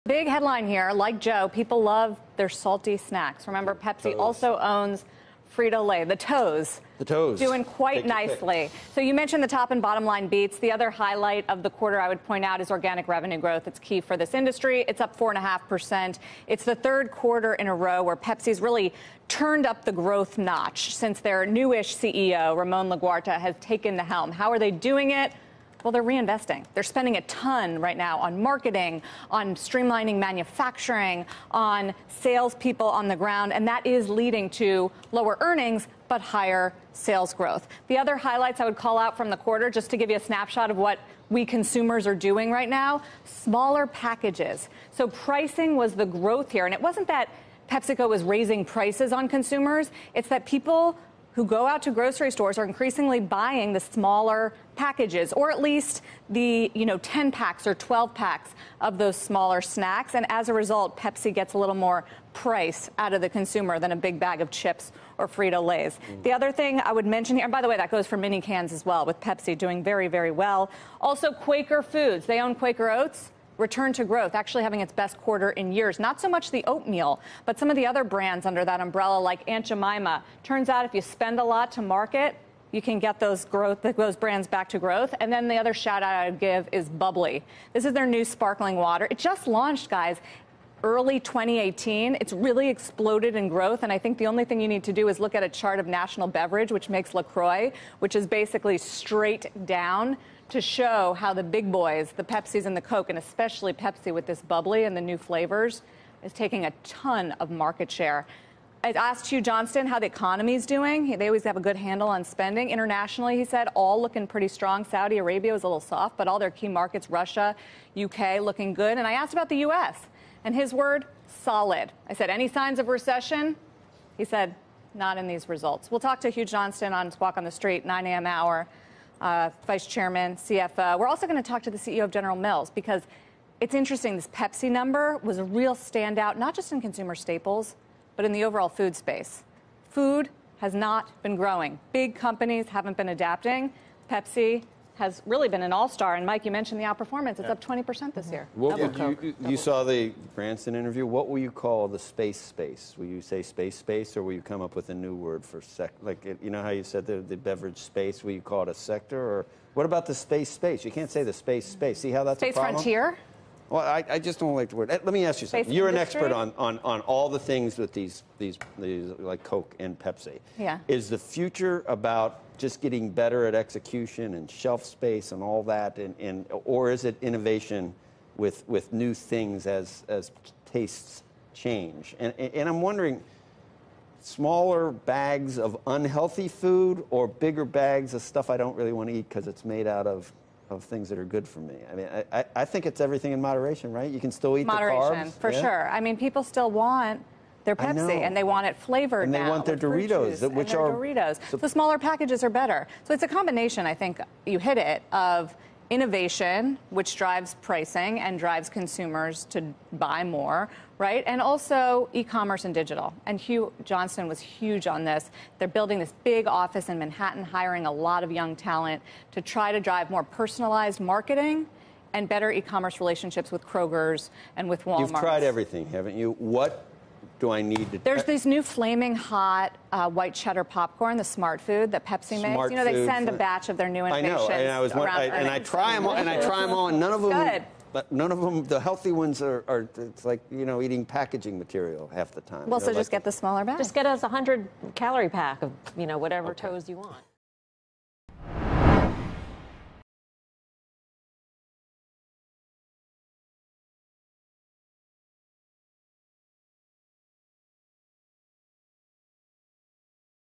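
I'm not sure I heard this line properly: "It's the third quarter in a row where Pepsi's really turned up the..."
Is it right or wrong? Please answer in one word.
right.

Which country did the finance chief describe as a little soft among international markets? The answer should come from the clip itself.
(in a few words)
Saudi Arabia.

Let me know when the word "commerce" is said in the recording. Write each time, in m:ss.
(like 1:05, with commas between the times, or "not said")
3:32, 3:42.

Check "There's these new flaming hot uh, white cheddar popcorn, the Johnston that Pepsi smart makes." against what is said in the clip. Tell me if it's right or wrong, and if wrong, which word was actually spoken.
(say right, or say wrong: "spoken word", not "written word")
wrong: "Smartfood", not "Johnston".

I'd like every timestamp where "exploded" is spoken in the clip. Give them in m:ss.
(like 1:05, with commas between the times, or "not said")
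1:32.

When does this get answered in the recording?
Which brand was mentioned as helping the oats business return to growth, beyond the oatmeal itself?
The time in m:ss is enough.
1:19.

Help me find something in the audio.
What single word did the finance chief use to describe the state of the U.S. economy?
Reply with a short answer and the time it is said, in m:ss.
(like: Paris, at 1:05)
solid, at 2:01.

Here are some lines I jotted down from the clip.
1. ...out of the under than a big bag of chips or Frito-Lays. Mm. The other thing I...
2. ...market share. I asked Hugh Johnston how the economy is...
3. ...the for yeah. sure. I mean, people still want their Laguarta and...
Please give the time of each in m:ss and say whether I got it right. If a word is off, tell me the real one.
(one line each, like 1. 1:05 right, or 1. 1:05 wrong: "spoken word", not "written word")
1. 1:02 wrong: "consumer", not "under"
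2. 1:47 right
3. 3:15 wrong: "Pepsi", not "Laguarta".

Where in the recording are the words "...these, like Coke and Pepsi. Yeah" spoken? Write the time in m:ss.
2:48.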